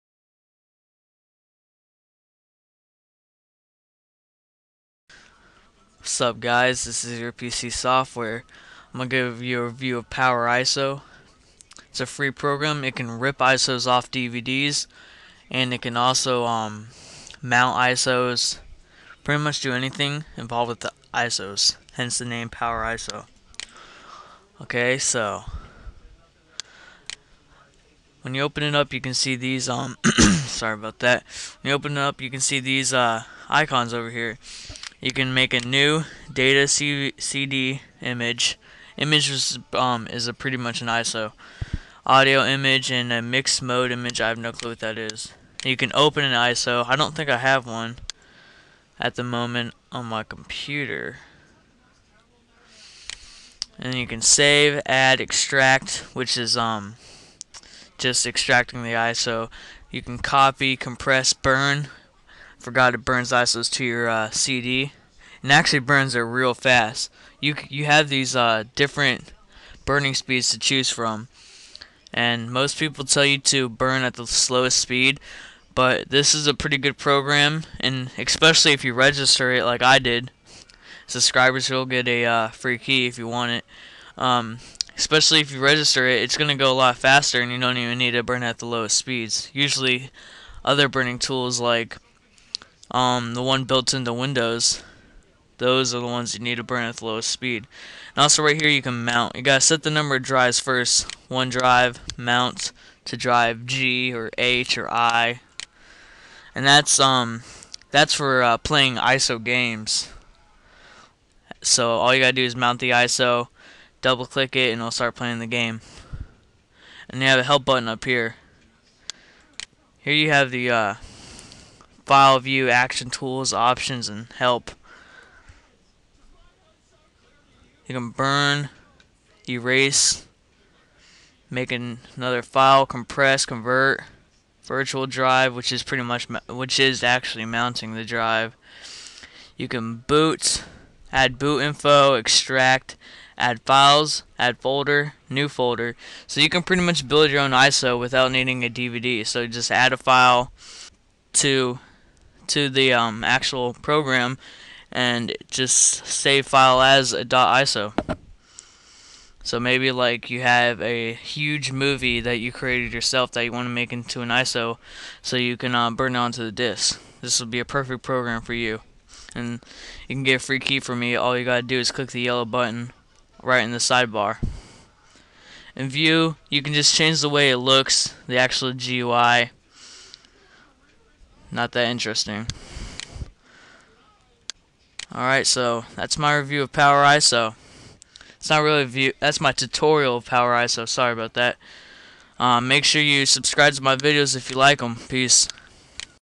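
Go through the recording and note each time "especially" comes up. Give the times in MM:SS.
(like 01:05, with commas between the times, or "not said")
01:18, 01:24.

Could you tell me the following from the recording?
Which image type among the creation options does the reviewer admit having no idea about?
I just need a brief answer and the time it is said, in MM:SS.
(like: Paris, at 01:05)
Mixed mode image, at 00:43.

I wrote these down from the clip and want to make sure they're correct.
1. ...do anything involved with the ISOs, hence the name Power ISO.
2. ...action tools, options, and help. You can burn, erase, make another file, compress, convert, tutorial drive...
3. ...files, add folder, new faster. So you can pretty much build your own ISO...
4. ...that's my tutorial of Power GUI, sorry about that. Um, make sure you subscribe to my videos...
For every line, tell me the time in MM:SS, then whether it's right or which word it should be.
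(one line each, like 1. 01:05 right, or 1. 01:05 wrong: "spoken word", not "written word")
1. 00:19 right
2. 02:02 wrong: "virtual", not "tutorial"
3. 02:23 wrong: "folder", not "faster"
4. 03:09 wrong: "ISO", not "GUI".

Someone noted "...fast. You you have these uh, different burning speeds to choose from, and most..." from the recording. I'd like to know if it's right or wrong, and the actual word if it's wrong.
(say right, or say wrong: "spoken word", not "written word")
right.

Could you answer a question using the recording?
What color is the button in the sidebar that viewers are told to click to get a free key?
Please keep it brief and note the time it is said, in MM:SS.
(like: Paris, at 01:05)
Yellow, at 02:52.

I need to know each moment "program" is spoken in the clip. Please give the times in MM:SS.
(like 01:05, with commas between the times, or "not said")
00:12, 01:16, 02:33, 02:48.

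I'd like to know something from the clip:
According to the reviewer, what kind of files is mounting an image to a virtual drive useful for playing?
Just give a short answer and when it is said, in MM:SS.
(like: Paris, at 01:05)
ISO games, at 01:48.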